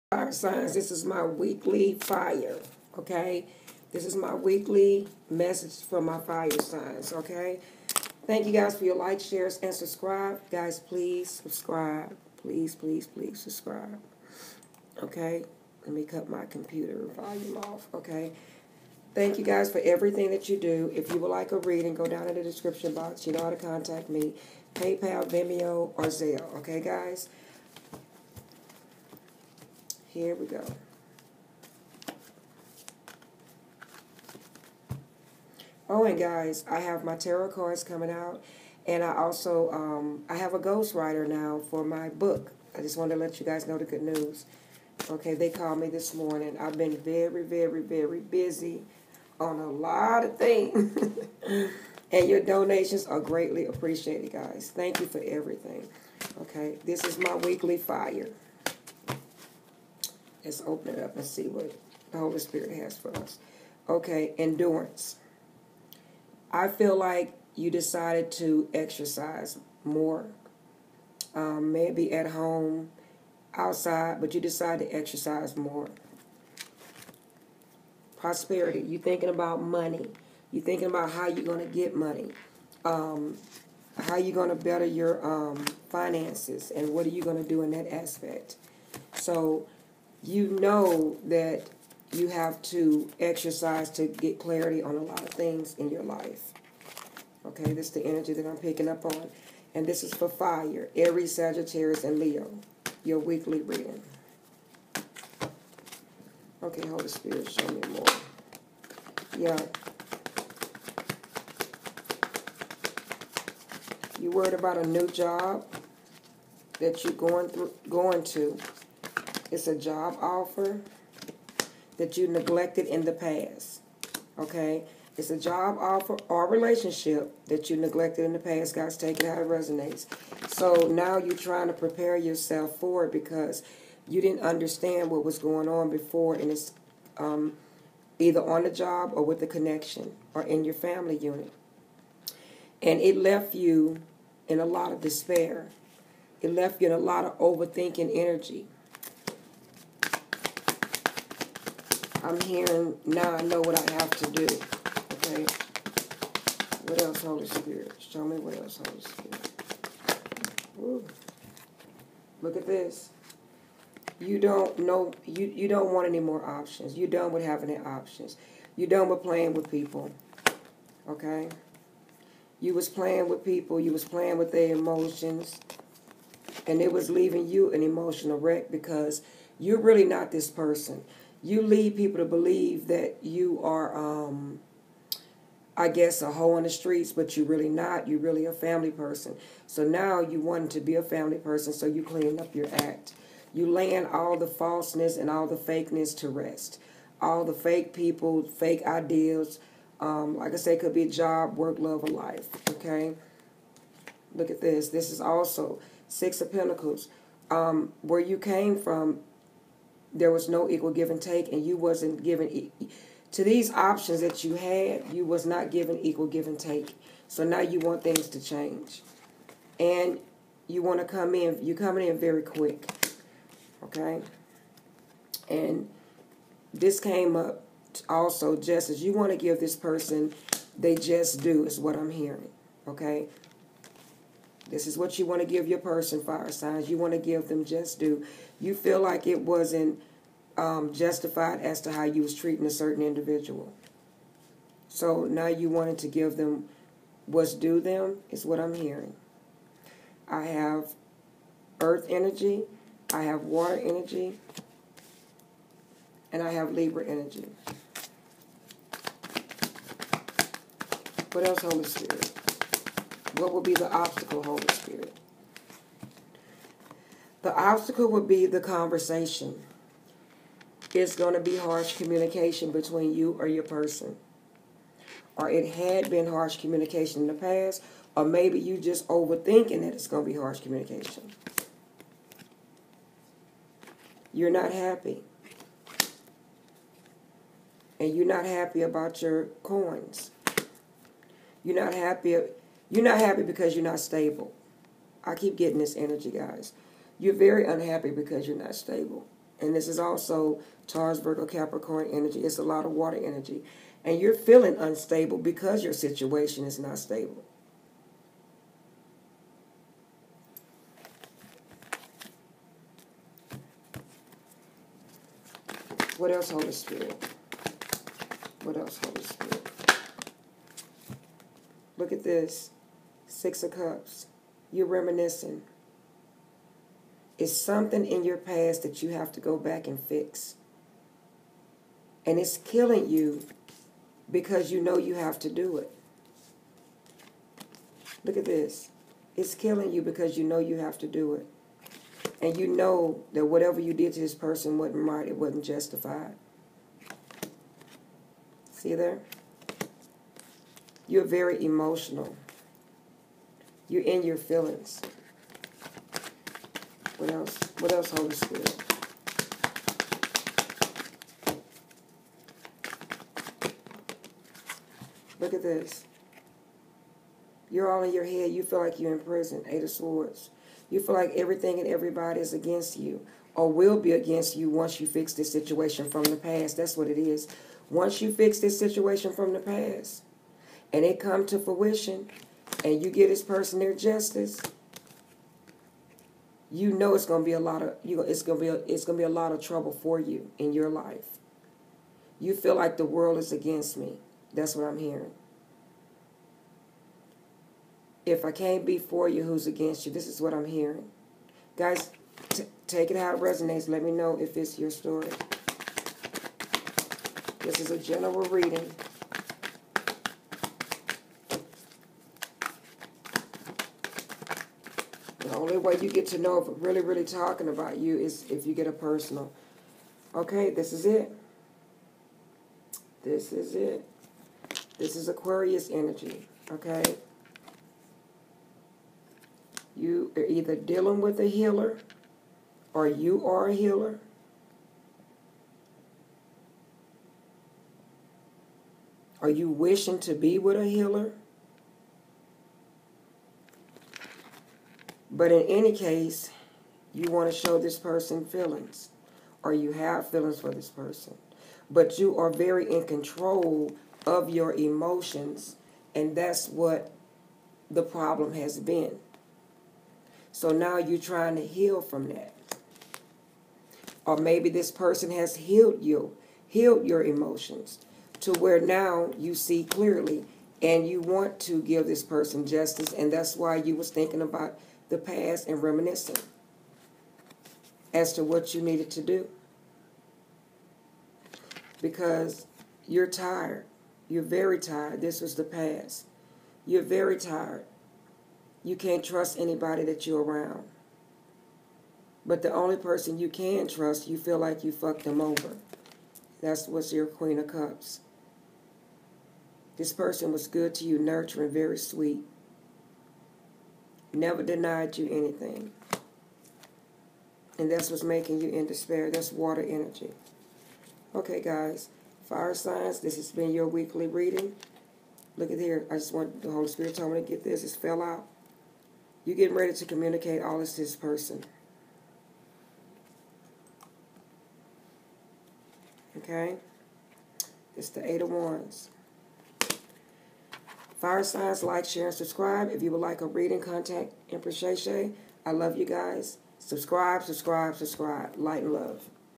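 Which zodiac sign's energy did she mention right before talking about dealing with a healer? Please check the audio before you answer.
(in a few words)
Aquarius.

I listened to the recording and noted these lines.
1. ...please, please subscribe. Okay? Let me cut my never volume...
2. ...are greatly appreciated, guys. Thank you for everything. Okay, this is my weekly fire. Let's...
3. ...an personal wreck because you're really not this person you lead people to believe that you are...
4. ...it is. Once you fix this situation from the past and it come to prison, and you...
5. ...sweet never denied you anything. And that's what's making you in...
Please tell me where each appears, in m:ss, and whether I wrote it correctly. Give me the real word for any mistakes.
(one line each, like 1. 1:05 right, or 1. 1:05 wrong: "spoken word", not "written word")
1. 0:12 wrong: "computer", not "never"
2. 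0:53 right
3. 2:57 wrong: "emotional", not "personal"
4. 6:17 wrong: "fruition", not "prison"
5. 8:21 right.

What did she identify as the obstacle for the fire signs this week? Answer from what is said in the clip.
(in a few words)
The conversation.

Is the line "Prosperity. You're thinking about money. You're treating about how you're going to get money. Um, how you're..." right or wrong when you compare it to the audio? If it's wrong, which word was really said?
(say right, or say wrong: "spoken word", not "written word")
wrong: "thinking", not "treating".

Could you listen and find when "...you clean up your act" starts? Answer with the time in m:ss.
3:11.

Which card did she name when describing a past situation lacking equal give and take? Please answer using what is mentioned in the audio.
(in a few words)
Six of Pentacles.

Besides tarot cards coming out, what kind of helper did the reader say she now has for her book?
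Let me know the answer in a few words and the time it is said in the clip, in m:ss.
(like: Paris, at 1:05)
Ghostwriter, at 0:40.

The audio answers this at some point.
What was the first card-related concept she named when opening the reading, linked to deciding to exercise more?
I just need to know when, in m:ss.
1:04.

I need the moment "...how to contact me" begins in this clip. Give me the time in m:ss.
0:23.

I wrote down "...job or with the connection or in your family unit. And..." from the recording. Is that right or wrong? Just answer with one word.
right.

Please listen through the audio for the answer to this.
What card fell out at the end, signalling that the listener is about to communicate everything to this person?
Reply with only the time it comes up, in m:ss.
8:48.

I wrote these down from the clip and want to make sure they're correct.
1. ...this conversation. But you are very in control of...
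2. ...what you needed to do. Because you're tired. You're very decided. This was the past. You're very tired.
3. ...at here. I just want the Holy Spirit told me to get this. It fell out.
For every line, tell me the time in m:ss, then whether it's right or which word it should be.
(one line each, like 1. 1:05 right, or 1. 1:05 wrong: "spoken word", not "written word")
1. 7:30 wrong: "person", not "conversation"
2. 7:58 wrong: "tired", not "decided"
3. 8:35 right.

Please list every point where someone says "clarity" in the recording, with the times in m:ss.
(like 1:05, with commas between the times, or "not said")
1:34.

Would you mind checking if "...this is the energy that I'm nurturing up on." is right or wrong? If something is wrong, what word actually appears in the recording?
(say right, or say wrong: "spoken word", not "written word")
wrong: "picking", not "nurturing".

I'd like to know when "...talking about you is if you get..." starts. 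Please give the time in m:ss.
6:57.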